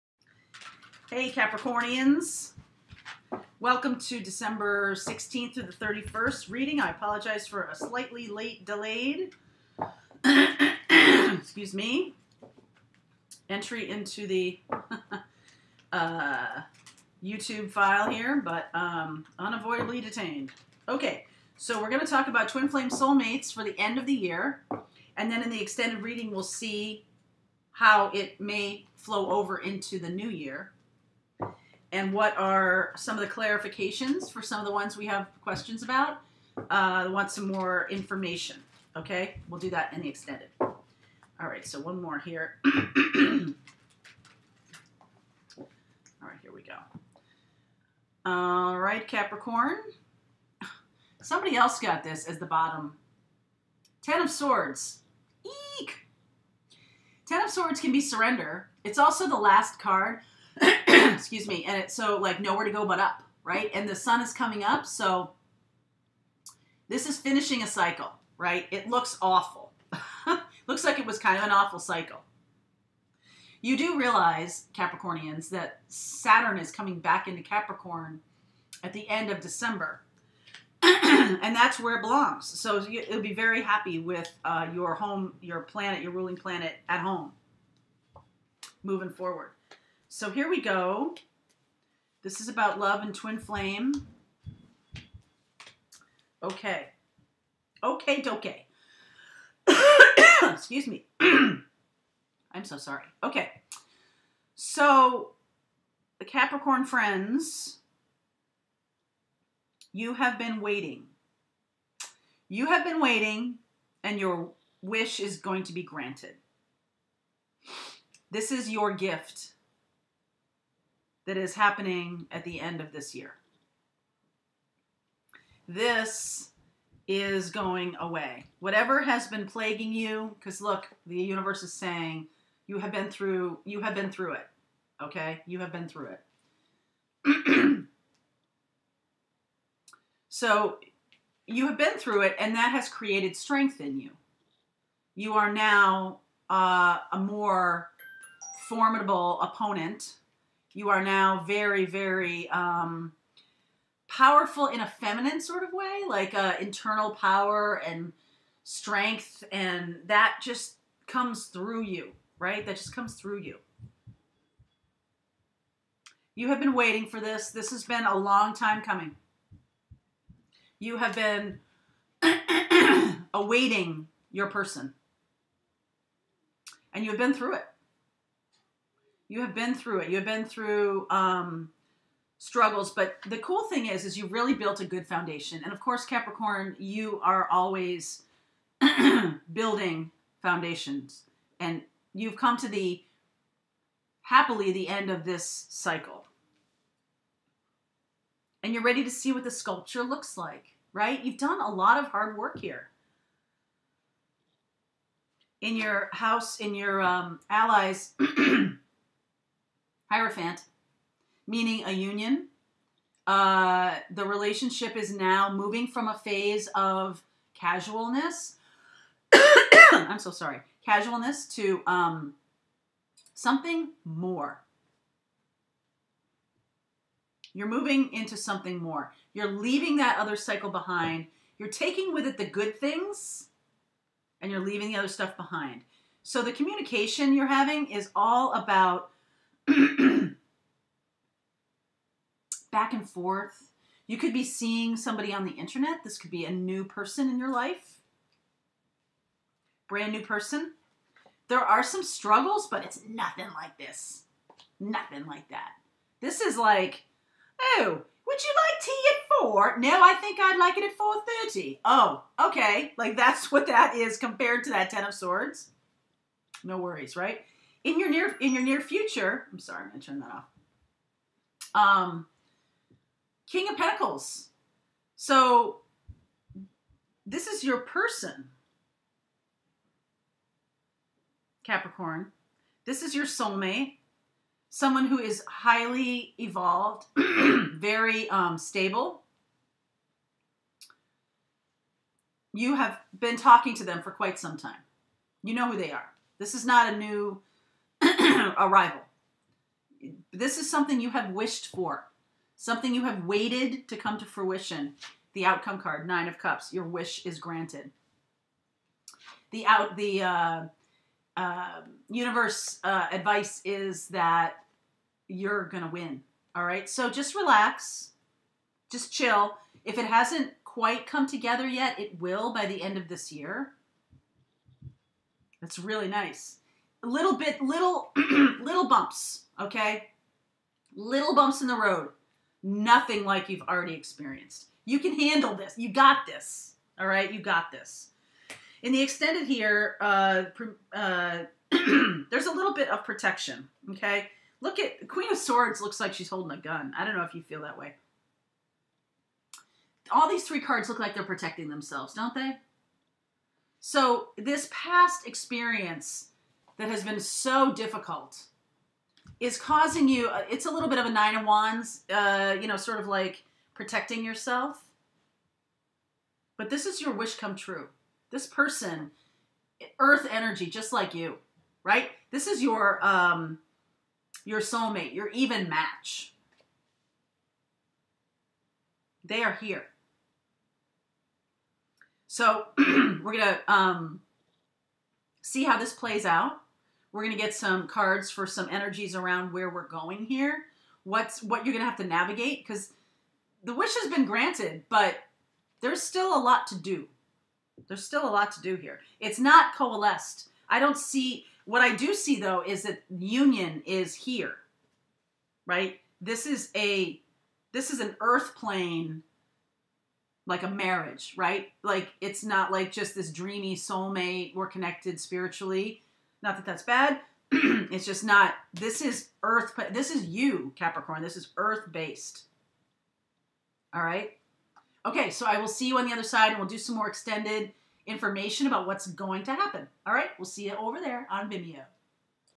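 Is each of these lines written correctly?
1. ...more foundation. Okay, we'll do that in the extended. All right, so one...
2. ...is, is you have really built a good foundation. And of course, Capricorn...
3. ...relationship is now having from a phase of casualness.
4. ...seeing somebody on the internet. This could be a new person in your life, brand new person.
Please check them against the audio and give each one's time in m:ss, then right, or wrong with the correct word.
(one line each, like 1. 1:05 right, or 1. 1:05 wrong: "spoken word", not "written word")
1. 0:37 wrong: "information", not "foundation"
2. 3:03 right
3. 3:34 wrong: "moving", not "having"
4. 4:04 right.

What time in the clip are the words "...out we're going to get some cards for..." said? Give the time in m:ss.
6:26.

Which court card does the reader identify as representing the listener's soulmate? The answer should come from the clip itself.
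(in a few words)
King of Pentacles.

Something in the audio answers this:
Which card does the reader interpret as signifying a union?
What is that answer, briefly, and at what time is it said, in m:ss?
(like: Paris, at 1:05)
Hierophant, at 3:30.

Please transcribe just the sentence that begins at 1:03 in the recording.
And the sun is coming up, so this is finishing a cycle, right?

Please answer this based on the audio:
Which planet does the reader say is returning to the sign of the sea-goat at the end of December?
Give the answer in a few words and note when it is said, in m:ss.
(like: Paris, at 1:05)
Saturn, at 1:15.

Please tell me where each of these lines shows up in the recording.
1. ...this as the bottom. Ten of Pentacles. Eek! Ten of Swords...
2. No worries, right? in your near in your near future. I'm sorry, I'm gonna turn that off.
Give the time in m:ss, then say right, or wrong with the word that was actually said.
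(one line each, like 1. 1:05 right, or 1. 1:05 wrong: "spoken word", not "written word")
1. 0:52 wrong: "Swords", not "Pentacles"
2. 4:26 right.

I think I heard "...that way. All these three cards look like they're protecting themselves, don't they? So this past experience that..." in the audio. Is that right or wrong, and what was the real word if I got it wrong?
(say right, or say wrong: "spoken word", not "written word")
right.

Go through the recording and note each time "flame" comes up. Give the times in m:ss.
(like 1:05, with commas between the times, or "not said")
0:22, 1:33.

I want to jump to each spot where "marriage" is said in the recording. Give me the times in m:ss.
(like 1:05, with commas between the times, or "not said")
6:50.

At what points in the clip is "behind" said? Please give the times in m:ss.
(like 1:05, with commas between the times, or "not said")
3:50, 3:55.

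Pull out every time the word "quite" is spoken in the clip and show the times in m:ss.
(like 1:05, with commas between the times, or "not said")
4:54, 5:20.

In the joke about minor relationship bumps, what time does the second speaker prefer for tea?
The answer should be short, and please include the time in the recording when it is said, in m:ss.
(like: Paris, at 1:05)
4:30, at 4:20.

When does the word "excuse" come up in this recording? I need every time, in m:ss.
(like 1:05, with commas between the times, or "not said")
0:10, 1:01, 1:40.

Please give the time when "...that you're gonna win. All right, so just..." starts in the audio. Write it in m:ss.
5:14.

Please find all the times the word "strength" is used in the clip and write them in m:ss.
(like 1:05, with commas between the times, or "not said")
2:23, 2:38.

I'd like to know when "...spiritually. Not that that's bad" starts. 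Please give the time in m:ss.
6:55.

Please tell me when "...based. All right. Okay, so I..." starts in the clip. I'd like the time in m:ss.
7:01.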